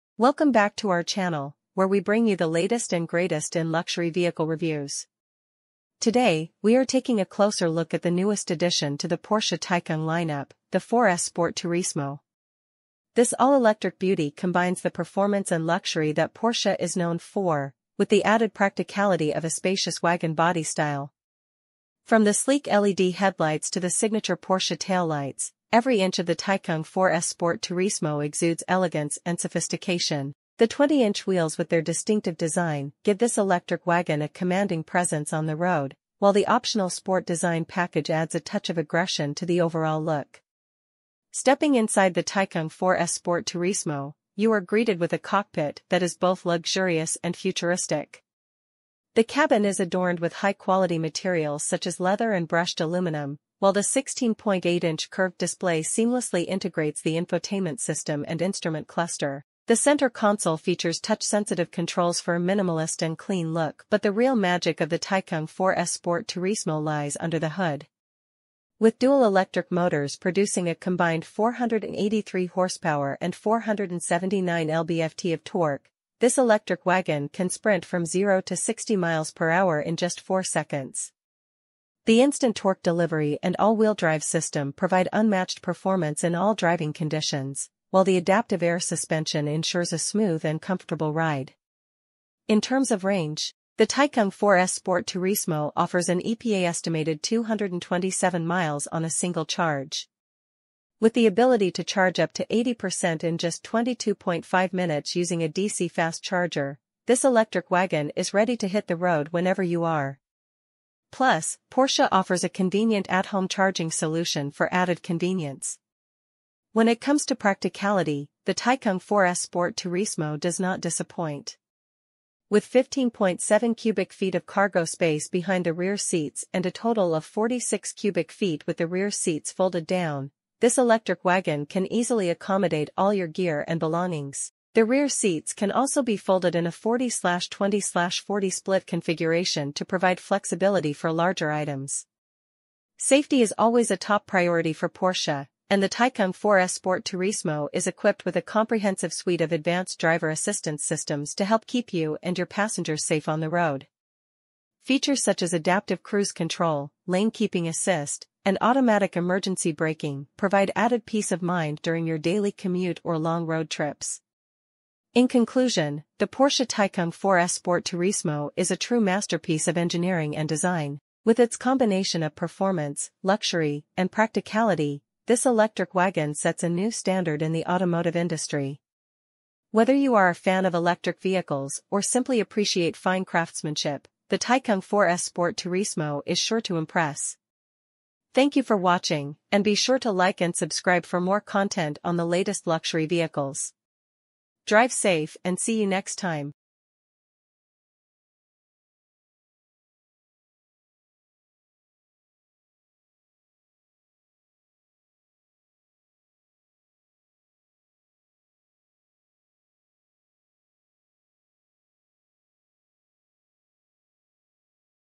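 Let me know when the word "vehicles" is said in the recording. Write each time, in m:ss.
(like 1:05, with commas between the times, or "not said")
0:04, 3:01, 3:13.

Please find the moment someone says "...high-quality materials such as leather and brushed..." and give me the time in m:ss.
0:50.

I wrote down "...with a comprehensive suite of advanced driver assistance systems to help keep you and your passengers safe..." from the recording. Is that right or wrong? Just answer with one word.
right.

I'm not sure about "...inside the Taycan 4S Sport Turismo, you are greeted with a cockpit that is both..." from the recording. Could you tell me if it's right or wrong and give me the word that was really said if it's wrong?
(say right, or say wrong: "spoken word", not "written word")
right.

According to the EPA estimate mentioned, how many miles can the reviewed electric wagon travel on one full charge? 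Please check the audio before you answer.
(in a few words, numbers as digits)
227 miles.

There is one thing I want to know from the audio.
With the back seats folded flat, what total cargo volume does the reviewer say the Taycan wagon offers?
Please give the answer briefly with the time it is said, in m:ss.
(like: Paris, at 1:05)
46 cubic feet, at 2:07.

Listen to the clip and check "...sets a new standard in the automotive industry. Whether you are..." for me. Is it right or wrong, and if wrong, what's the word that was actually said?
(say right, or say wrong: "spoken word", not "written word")
right.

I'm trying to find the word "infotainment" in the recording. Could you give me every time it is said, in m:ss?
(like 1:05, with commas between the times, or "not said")
0:57.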